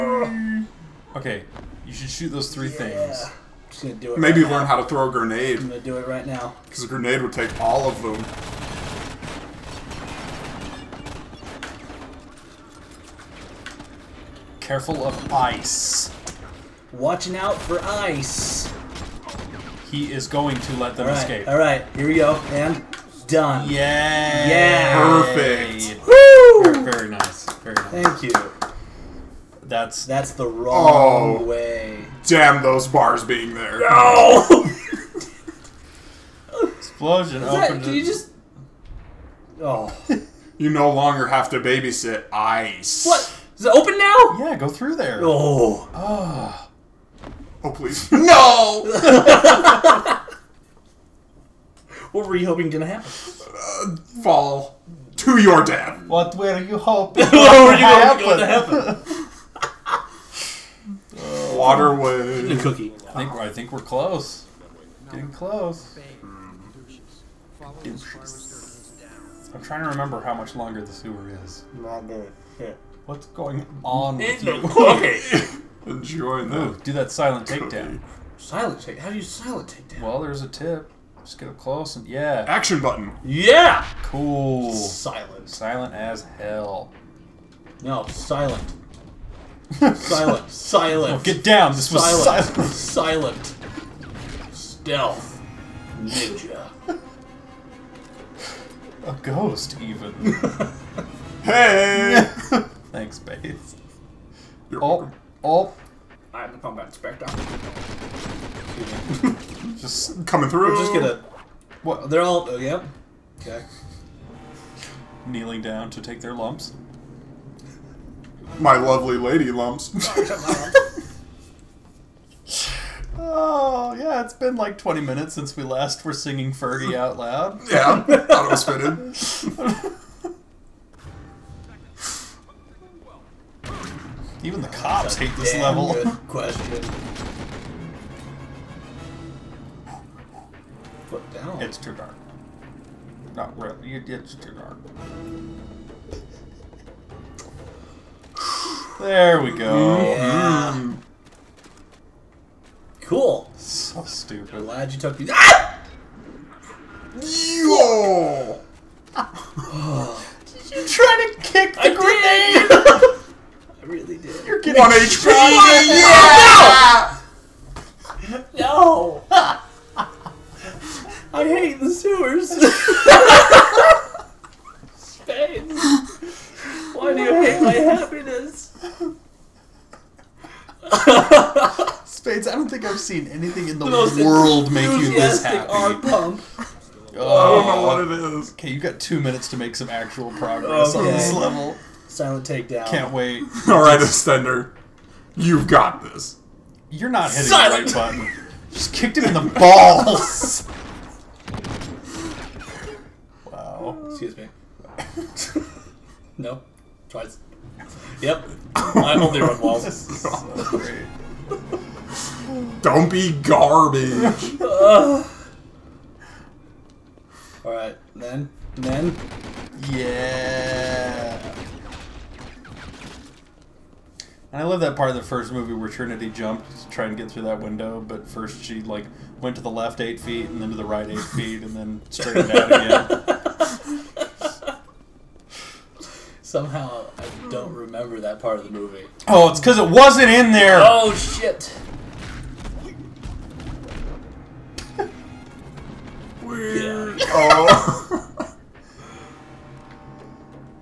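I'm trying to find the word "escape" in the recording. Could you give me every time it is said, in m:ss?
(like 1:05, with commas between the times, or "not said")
0:21.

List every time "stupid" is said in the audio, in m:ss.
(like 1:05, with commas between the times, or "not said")
2:34.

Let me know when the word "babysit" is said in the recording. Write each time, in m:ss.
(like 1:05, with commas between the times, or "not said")
0:41.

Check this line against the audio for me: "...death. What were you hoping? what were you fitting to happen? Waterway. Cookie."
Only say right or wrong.
wrong.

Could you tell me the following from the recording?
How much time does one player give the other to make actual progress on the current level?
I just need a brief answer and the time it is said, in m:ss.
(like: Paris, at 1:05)
2 minutes, at 3:08.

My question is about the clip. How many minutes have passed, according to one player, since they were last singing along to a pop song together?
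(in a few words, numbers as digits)
20.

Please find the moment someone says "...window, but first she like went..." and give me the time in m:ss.
3:47.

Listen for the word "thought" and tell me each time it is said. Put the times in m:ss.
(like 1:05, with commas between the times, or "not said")
2:08.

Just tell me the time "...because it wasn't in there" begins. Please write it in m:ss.
3:59.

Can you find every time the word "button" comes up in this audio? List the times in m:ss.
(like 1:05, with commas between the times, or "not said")
1:22, 3:18.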